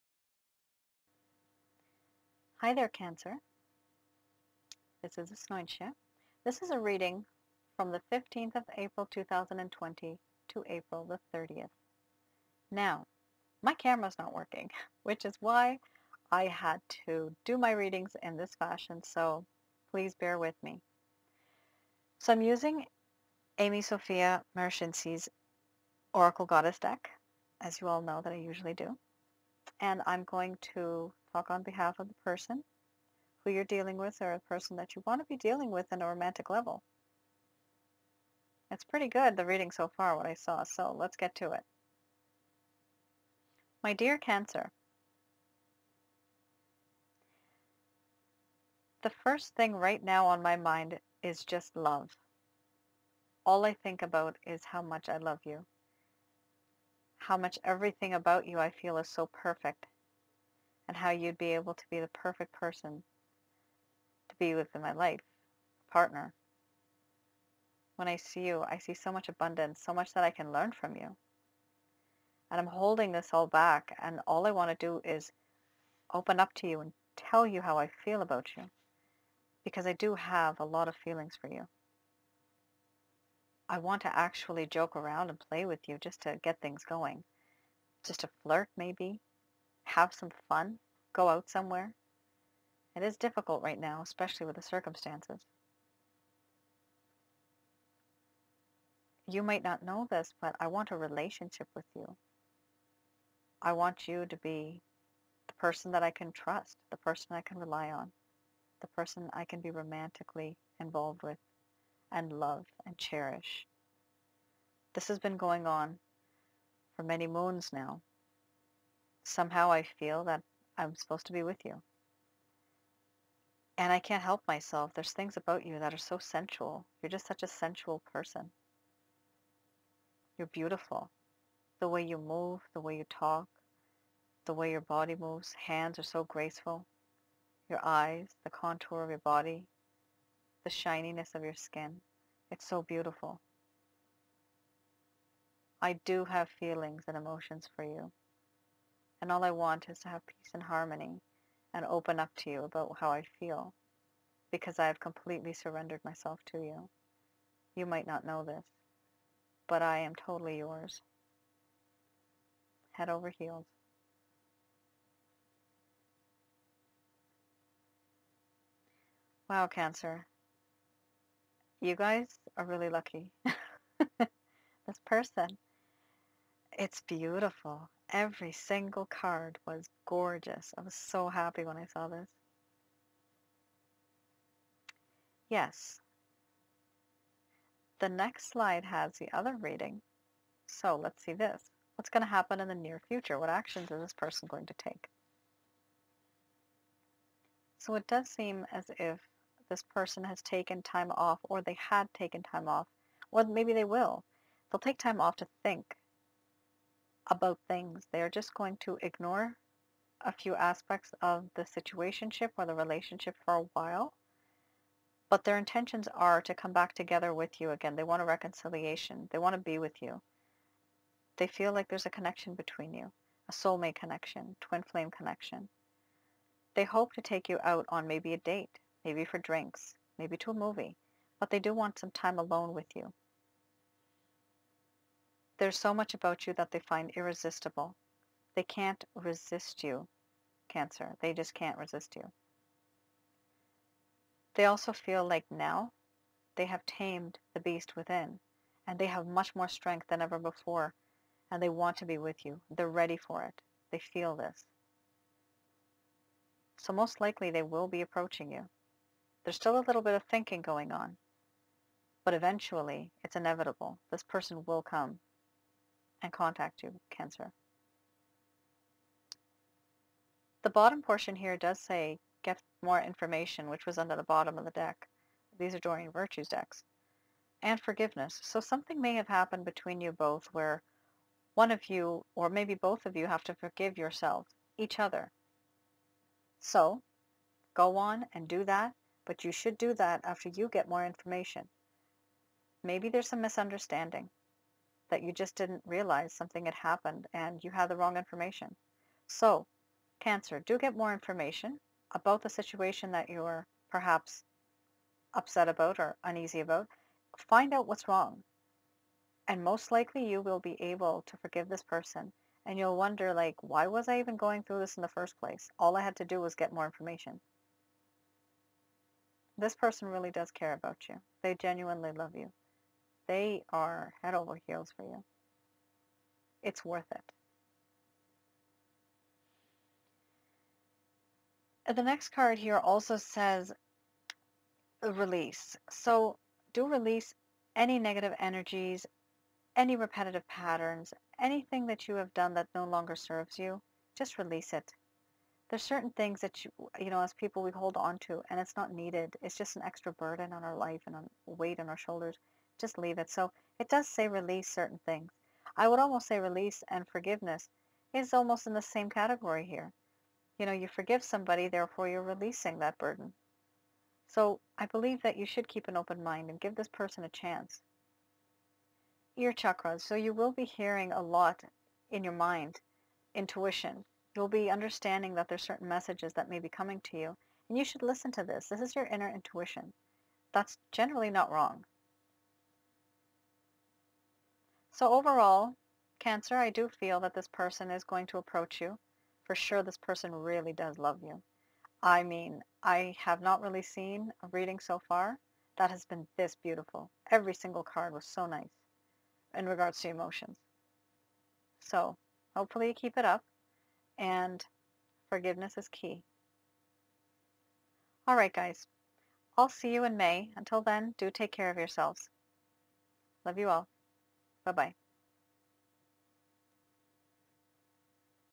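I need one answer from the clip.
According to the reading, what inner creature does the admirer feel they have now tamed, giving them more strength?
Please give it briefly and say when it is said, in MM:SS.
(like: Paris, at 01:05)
the beast within, at 04:07.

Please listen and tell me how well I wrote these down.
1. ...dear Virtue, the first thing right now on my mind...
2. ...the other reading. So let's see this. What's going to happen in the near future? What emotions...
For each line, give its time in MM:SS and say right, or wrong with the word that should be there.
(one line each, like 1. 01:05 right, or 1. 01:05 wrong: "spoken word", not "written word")
1. 00:43 wrong: "Cancer", not "Virtue"
2. 03:09 wrong: "actions", not "emotions".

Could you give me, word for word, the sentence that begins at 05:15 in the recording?
All I had to do was get more information this person really does care about you.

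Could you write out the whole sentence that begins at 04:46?
So, go on and do that but you should do that after you get more information.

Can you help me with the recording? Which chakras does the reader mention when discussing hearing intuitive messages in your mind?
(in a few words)
ear chakras.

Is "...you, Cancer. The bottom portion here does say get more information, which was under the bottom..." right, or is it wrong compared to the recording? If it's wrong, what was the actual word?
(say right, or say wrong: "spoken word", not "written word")
right.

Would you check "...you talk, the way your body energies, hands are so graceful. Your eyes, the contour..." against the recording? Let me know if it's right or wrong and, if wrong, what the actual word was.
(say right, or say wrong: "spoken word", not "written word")
wrong: "moves", not "energies".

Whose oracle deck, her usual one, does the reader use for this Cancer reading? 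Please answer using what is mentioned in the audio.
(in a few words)
Amy Sophia Marashinsky.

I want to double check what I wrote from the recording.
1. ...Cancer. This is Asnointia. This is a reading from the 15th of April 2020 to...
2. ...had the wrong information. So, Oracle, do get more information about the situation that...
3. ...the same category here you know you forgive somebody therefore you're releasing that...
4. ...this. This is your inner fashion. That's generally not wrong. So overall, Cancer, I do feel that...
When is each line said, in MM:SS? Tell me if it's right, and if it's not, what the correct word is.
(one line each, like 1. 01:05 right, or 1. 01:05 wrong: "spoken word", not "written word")
1. 00:02 right
2. 04:57 wrong: "Cancer", not "Oracle"
3. 05:58 right
4. 06:18 wrong: "intuition", not "fashion".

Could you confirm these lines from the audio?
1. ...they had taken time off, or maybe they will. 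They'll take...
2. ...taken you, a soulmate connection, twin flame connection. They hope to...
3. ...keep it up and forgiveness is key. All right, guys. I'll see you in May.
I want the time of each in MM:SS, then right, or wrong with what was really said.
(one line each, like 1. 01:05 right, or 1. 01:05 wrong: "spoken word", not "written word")
1. 03:21 right
2. 03:42 wrong: "between", not "taken"
3. 06:42 right.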